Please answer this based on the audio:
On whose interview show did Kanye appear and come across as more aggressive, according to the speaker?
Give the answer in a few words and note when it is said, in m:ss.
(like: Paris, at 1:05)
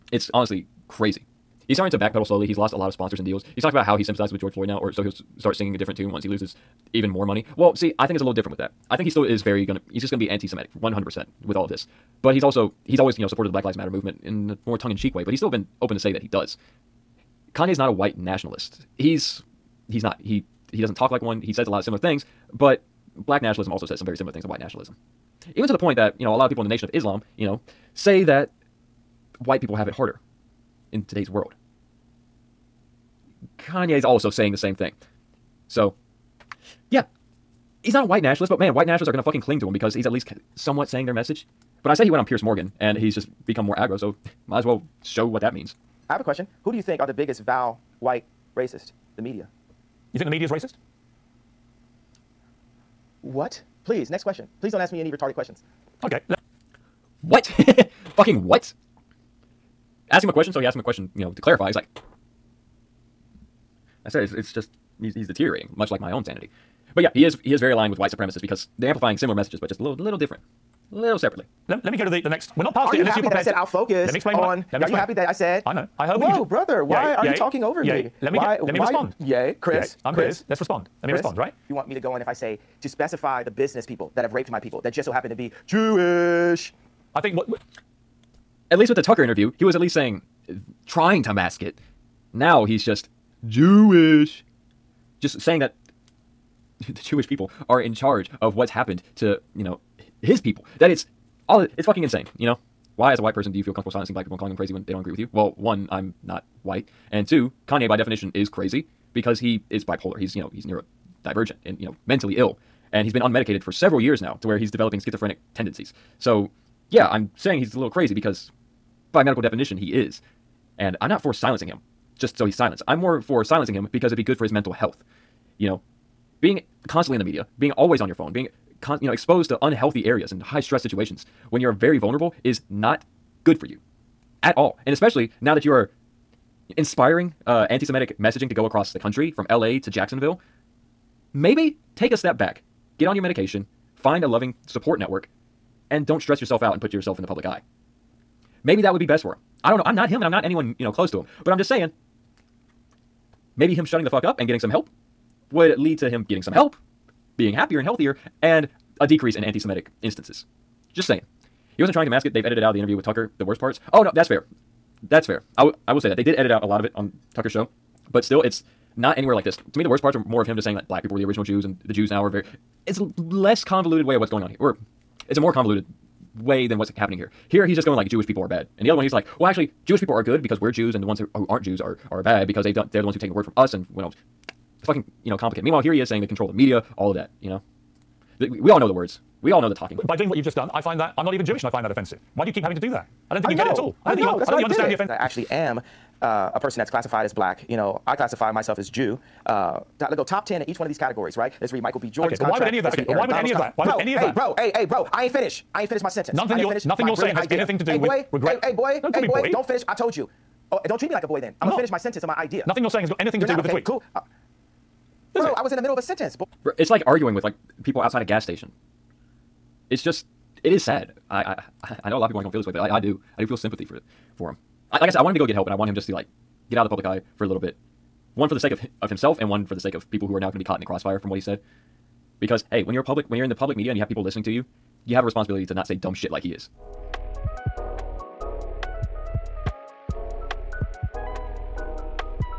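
Piers Morgan, at 0:42.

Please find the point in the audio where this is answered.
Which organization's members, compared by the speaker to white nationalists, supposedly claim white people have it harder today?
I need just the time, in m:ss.
0:26.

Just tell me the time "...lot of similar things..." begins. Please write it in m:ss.
0:21.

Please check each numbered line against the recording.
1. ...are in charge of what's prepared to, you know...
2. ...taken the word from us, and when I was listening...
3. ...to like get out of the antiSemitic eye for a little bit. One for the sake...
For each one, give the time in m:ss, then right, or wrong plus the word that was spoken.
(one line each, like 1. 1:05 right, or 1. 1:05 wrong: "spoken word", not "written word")
1. 1:37 wrong: "happened", not "prepared"
2. 3:03 wrong: "fucking", not "listening"
3. 3:46 wrong: "public", not "antiSemitic".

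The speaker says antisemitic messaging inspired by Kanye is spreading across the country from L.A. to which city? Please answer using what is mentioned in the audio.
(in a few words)
Jacksonville.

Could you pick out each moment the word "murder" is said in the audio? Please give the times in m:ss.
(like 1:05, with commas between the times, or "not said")
not said.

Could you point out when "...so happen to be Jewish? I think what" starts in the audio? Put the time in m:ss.
1:25.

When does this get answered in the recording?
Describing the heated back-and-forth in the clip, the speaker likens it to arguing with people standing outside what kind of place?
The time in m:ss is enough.
3:38.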